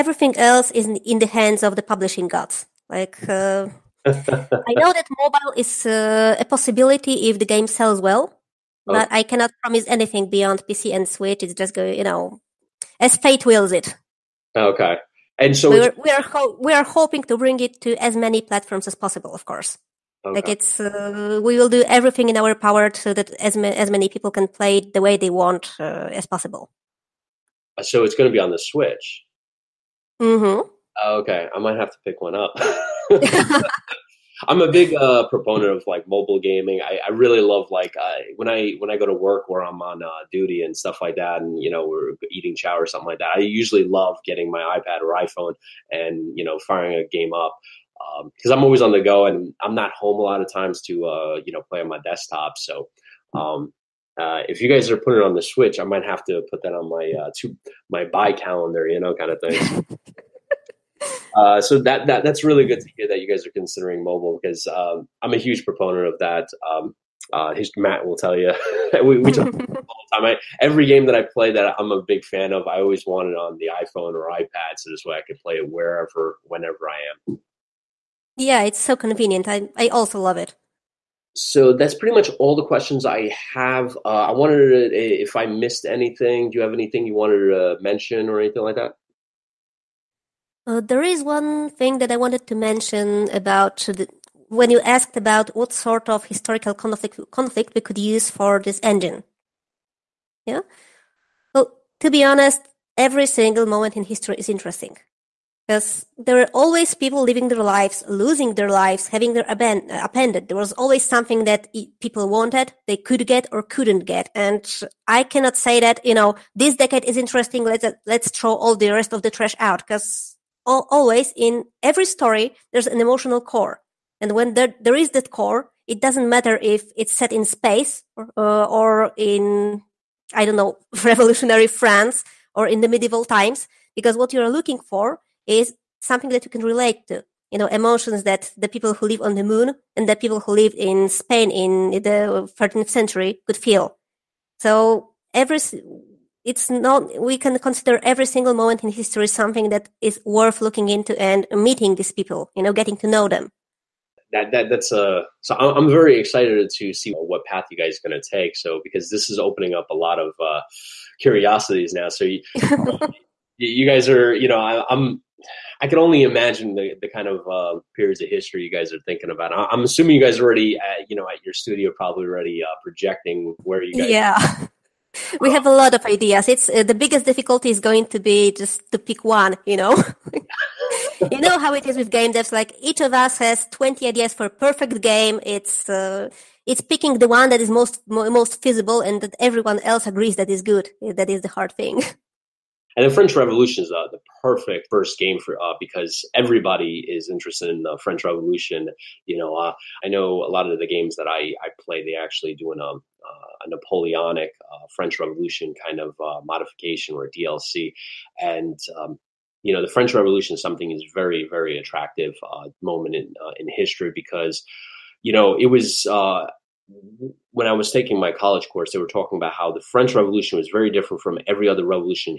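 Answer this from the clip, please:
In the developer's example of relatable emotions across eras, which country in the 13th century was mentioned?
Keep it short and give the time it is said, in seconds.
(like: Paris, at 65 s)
Spain, at 141 s.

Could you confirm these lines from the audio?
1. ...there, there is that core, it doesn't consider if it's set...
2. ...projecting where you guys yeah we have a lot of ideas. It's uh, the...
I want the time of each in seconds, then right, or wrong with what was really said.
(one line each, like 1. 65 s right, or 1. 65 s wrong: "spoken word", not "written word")
1. 124 s wrong: "matter", not "consider"
2. 172 s right.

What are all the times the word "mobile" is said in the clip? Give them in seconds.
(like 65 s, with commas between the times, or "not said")
5 s, 36 s, 64 s.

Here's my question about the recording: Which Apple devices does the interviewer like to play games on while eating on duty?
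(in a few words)
iPad or iPhone.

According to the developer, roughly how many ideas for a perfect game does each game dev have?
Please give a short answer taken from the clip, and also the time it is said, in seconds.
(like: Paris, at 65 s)
20, at 183 s.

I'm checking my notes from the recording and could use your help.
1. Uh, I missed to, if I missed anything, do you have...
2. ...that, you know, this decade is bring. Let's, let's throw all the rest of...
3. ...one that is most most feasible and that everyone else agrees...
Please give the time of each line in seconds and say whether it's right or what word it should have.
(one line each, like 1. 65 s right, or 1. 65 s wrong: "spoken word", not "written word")
1. 84 s wrong: "wanted", not "missed"
2. 115 s wrong: "interesting", not "bring"
3. 187 s right.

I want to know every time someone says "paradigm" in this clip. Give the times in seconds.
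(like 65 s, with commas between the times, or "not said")
not said.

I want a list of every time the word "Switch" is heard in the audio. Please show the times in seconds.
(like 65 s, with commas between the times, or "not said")
11 s, 28 s, 55 s.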